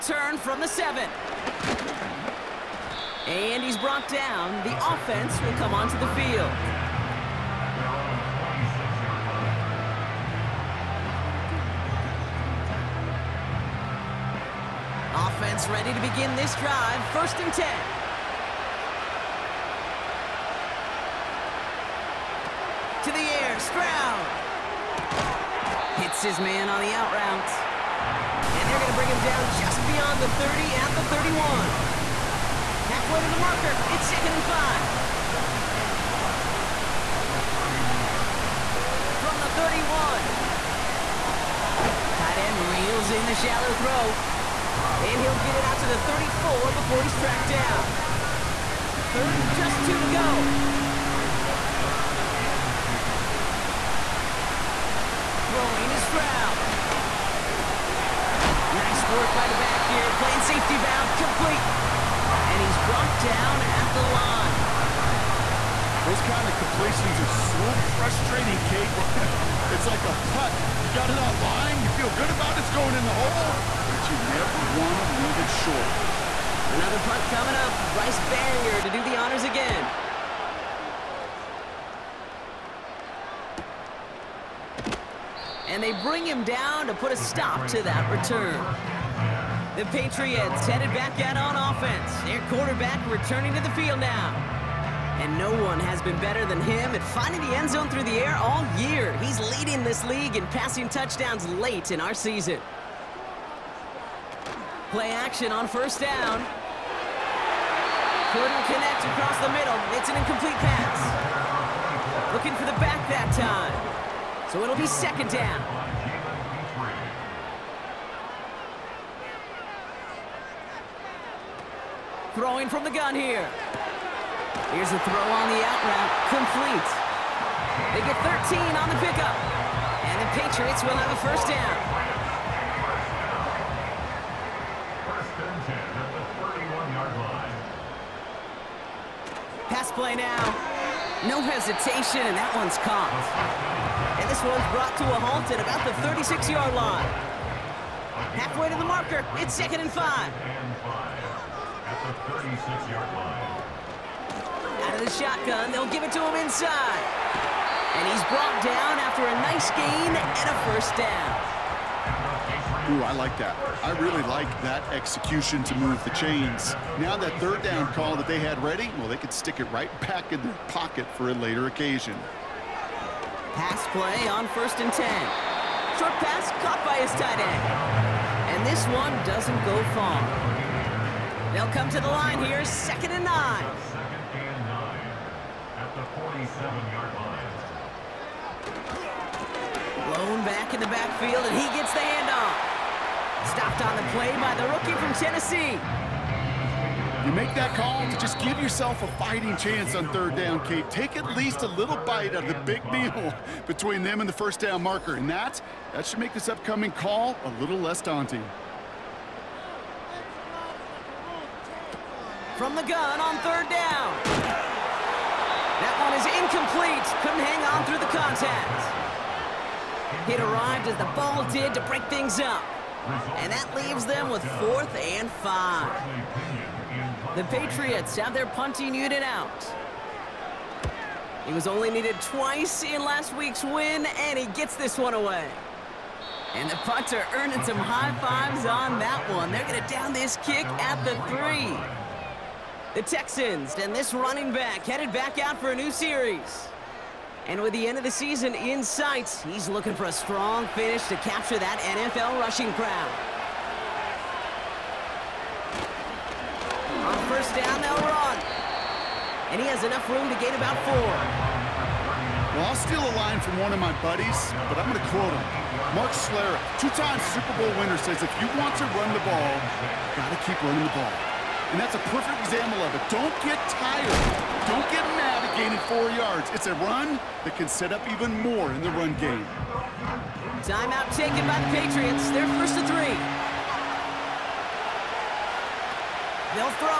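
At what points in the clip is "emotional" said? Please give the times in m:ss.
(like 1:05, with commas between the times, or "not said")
not said.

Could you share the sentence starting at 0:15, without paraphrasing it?
Offense ready to begin this drive.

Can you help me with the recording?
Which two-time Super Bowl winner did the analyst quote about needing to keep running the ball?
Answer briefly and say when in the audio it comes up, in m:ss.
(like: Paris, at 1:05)
Mark Schlereth, at 4:25.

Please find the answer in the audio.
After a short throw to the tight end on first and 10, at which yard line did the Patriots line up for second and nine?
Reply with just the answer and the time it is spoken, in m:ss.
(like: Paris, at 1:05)
47-yard line, at 3:05.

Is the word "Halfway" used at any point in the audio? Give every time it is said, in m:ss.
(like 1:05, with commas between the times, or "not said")
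0:32, 2:28.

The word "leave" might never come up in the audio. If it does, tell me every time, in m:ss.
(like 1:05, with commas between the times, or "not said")
1:15, 3:43.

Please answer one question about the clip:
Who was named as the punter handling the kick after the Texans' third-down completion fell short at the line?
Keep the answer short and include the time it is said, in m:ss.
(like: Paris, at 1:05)
Bryce Baringer, at 1:17.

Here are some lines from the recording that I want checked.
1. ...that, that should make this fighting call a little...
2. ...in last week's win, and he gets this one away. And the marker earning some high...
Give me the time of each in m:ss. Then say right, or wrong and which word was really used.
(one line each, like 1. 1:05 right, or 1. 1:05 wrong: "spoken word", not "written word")
1. 3:25 wrong: "upcoming", not "fighting"
2. 3:52 wrong: "punter", not "marker".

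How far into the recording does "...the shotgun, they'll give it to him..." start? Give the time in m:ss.
2:35.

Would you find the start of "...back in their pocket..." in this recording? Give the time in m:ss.
2:49.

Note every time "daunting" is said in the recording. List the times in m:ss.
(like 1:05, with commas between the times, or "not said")
3:27.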